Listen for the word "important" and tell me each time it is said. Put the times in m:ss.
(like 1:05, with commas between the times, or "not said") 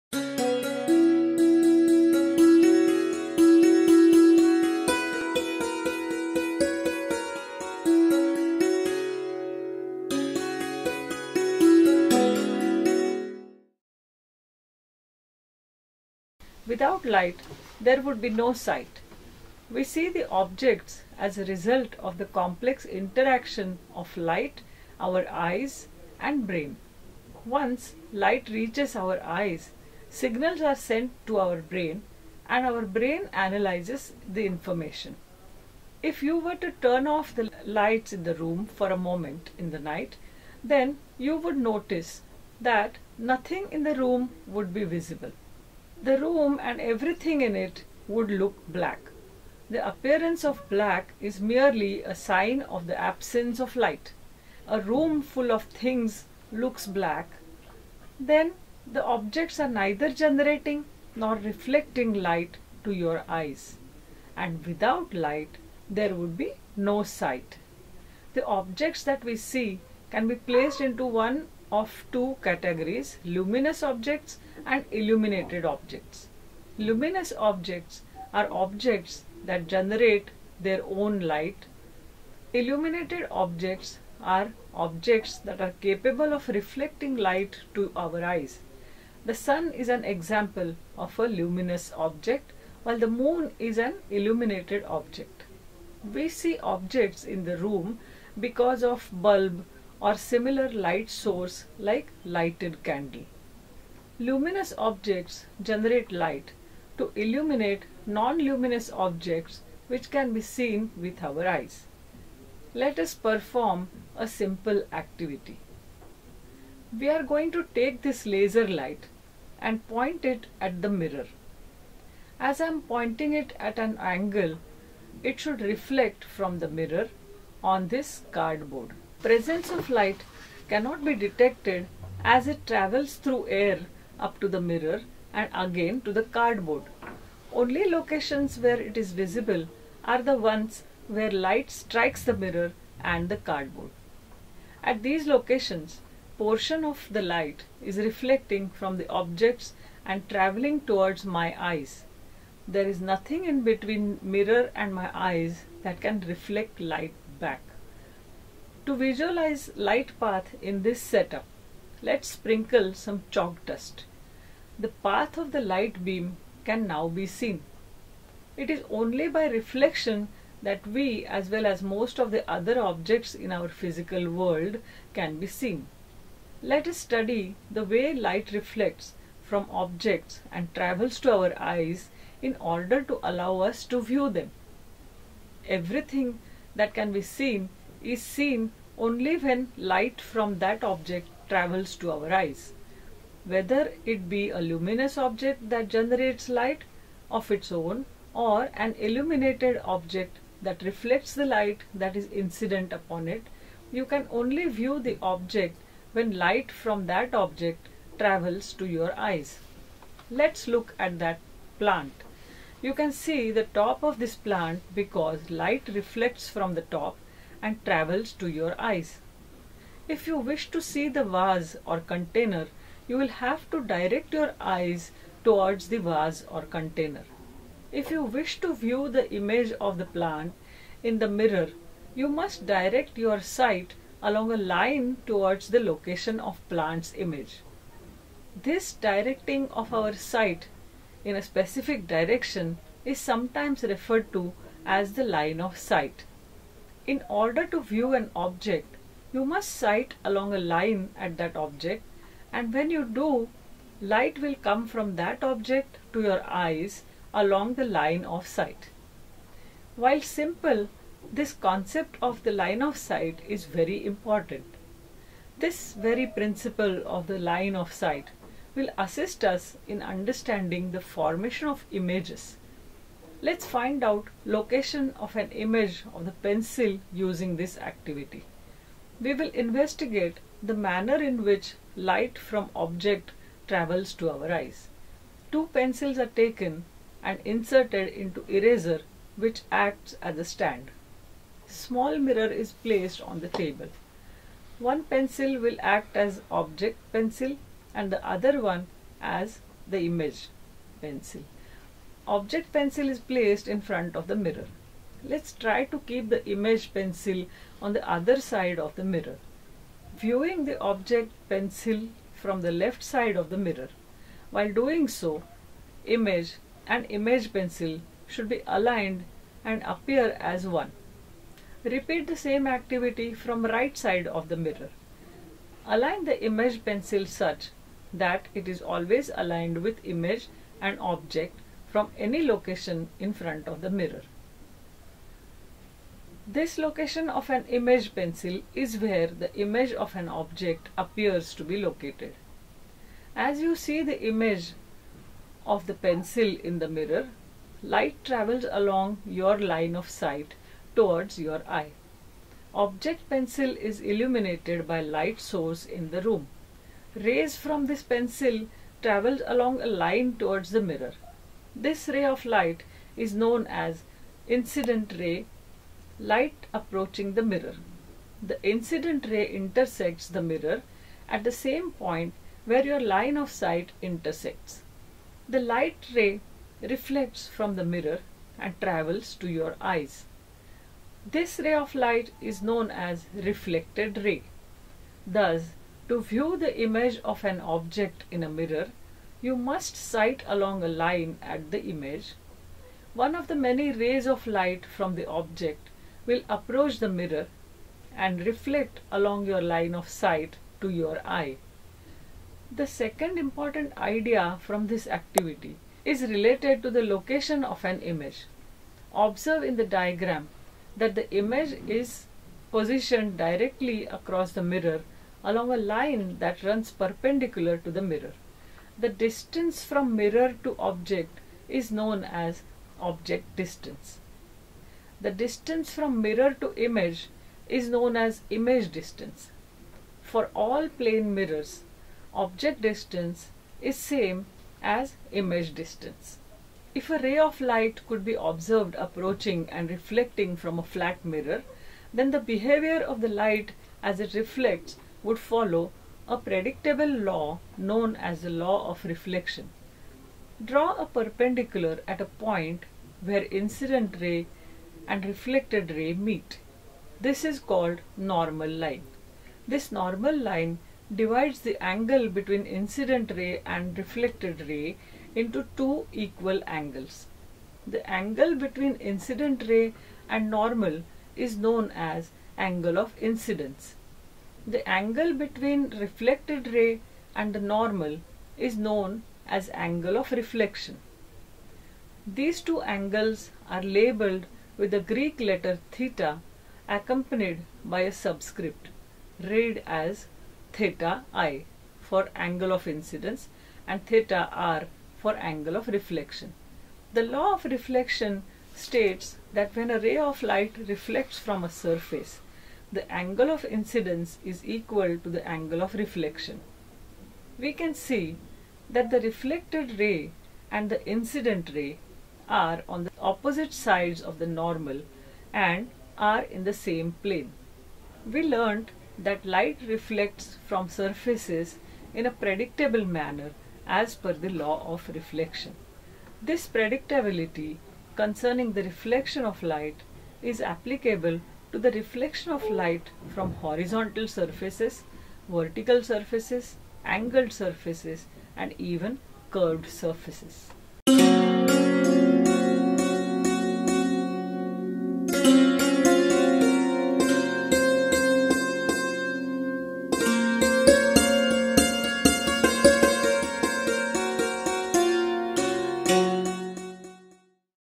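4:24, 6:43.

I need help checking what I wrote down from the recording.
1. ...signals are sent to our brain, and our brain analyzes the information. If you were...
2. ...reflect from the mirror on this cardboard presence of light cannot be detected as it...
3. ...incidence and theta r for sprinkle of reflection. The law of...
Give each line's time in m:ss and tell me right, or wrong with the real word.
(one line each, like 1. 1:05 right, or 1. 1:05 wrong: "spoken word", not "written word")
1. 0:30 right
2. 2:05 right
3. 8:12 wrong: "angle", not "sprinkle".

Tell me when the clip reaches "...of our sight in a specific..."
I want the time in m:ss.
3:59.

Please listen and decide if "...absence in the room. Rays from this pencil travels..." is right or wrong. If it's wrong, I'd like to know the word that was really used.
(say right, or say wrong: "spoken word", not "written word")
wrong: "source", not "absence".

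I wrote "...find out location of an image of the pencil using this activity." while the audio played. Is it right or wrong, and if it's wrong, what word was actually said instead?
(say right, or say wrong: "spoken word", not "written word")
right.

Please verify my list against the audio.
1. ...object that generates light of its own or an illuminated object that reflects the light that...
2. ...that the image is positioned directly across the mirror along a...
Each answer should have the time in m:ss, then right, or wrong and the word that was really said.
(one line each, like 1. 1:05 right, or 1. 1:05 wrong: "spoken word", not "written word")
1. 3:15 right
2. 6:50 right.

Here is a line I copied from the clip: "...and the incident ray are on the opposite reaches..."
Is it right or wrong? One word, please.
wrong.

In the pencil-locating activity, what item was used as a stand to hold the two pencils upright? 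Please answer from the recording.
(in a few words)
Eraser.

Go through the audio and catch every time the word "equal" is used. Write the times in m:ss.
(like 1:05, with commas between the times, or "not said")
7:46, 8:24.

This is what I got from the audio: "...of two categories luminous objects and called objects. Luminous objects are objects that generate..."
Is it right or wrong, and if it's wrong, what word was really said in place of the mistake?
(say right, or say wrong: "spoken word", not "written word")
wrong: "illuminated", not "called".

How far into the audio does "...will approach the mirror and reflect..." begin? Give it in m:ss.
6:36.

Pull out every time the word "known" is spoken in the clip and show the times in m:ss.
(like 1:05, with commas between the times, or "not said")
6:03, 6:22, 7:01, 7:07, 7:27, 7:51, 7:58.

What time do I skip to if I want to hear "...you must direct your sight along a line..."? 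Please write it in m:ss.
3:52.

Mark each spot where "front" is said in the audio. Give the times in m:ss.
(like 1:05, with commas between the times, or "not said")
5:03, 5:33.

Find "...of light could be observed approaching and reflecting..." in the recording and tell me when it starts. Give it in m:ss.
7:17.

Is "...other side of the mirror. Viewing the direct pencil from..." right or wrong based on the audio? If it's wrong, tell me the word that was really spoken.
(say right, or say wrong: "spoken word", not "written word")
wrong: "object", not "direct".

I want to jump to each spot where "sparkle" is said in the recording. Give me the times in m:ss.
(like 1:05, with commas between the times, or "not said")
not said.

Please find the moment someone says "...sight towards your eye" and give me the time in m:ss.
5:50.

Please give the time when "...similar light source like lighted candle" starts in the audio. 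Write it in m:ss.
1:40.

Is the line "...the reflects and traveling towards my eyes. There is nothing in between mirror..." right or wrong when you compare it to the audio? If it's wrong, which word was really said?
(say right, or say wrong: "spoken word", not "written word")
wrong: "objects", not "reflects".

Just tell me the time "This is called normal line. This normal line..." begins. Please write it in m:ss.
7:37.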